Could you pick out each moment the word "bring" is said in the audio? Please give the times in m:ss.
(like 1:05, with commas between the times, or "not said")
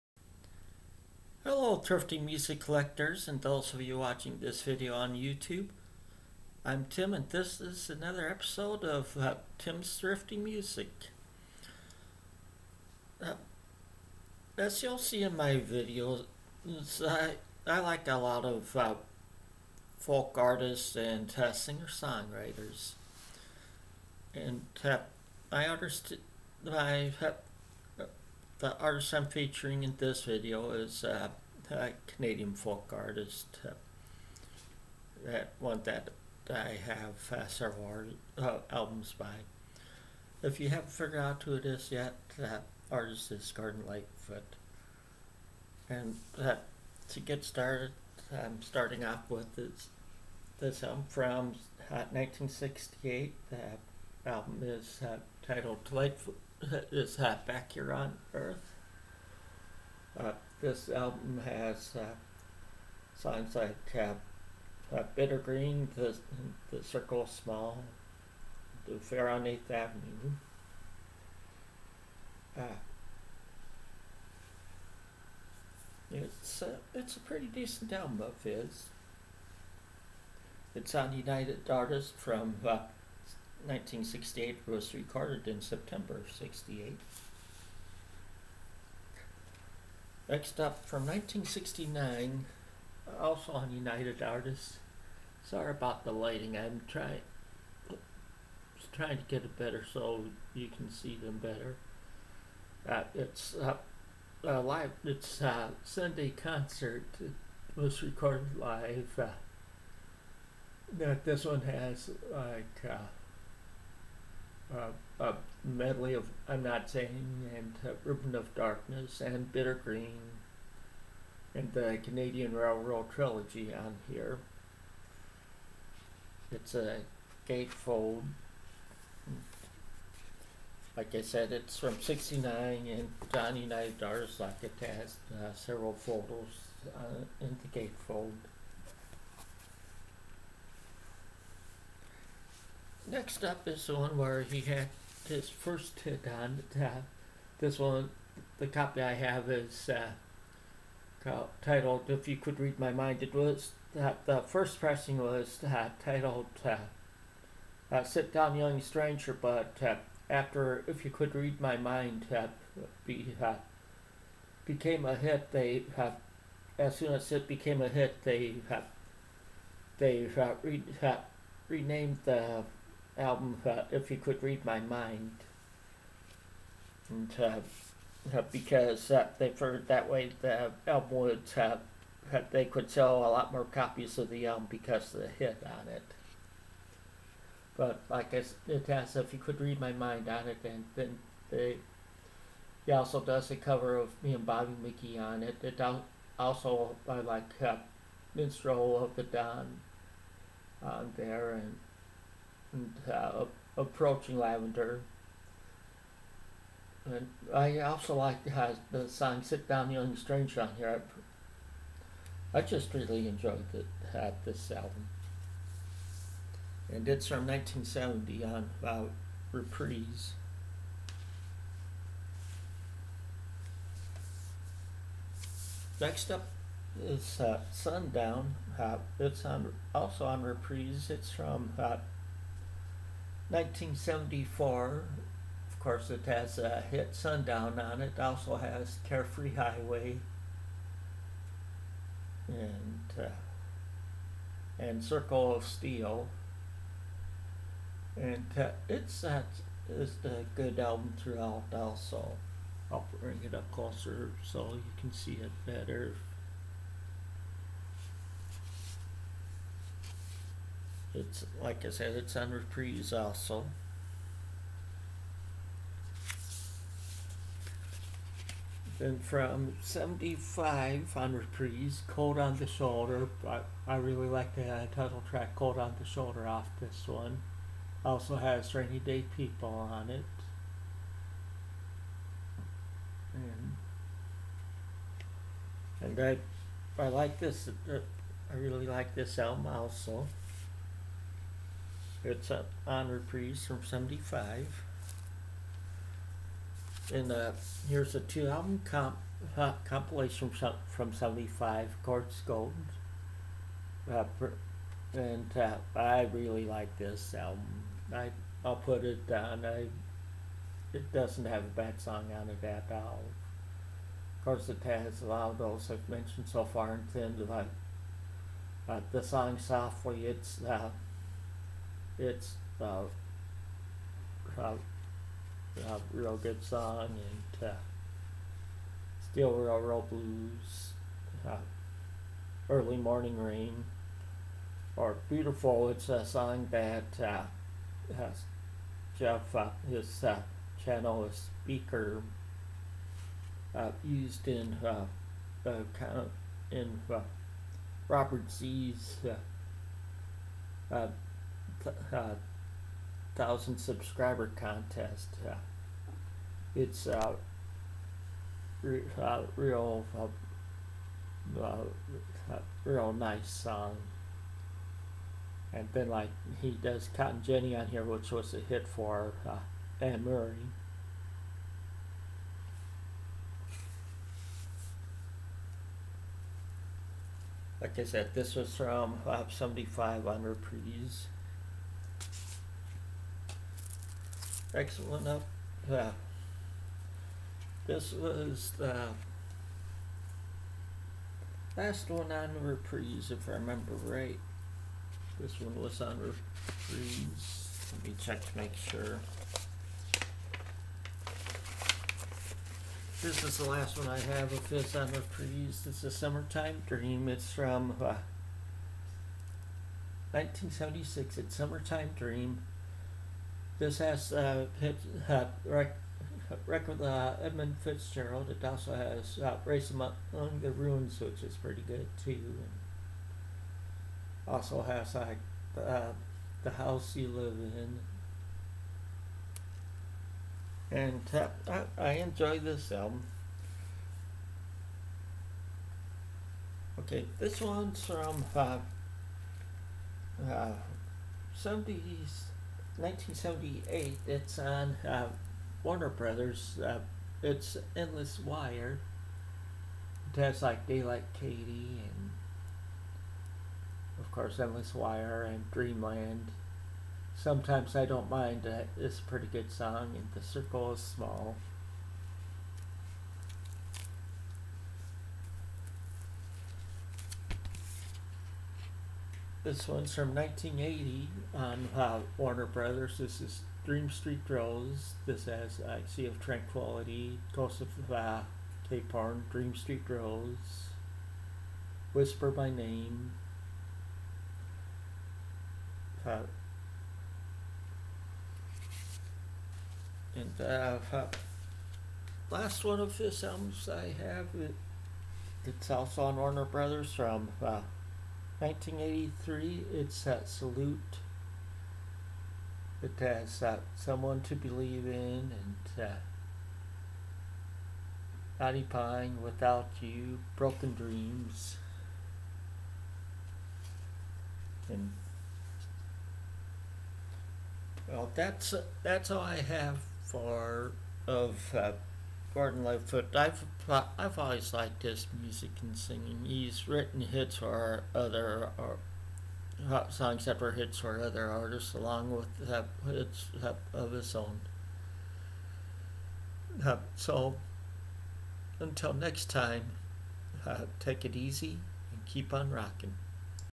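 4:13.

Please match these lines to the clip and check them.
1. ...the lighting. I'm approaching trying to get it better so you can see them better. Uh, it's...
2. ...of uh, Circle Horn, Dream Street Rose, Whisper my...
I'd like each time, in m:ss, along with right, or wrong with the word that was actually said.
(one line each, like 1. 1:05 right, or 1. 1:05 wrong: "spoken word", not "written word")
1. 1:36 wrong: "trying", not "approaching"
2. 7:57 wrong: "Cape", not "Circle".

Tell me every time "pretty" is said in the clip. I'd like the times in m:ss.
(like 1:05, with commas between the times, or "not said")
1:17, 7:01, 7:39.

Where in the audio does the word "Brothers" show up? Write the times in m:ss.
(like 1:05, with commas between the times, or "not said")
7:26, 7:52, 8:16.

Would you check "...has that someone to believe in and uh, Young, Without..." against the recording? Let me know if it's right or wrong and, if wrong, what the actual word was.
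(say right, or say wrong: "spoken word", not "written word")
wrong: "Pine", not "Young".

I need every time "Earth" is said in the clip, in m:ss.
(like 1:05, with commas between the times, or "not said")
0:58.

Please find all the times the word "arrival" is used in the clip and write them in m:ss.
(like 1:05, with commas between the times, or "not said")
not said.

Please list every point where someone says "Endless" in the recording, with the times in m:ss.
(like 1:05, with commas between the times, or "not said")
7:27, 7:34.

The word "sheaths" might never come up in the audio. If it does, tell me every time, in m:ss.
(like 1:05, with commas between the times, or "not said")
not said.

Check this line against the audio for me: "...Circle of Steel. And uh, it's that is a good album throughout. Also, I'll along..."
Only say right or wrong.
wrong.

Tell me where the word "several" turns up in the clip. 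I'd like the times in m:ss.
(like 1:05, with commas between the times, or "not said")
0:37, 2:15.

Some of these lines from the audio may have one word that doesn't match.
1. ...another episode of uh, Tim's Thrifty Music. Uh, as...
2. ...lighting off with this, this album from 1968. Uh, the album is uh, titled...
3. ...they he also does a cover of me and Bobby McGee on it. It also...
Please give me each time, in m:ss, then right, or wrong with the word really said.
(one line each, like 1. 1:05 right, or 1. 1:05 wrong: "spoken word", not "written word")
1. 0:07 right
2. 0:48 wrong: "starting", not "lighting"
3. 3:11 right.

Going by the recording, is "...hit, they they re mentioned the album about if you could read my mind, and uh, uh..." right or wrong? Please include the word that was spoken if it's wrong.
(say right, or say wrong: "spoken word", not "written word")
wrong: "renamed", not "mentioned".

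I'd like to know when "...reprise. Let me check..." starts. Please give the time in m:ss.
6:36.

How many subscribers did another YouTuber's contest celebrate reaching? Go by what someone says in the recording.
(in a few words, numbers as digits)
1000.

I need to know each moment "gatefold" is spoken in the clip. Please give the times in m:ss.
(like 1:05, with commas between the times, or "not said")
2:07, 2:17.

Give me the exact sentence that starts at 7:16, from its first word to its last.
Okay, this one's from uh, uh, 70s 1978.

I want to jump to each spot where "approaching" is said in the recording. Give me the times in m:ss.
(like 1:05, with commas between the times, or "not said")
3:23.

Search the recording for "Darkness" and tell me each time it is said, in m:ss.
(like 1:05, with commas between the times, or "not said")
1:58.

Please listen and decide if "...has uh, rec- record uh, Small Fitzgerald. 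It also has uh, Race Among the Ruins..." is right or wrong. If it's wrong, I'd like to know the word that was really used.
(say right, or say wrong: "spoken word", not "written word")
wrong: "Edmund", not "Small".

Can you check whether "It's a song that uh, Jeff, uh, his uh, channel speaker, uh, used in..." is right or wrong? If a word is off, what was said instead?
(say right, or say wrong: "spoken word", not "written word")
right.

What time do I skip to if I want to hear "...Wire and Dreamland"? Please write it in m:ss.
7:34.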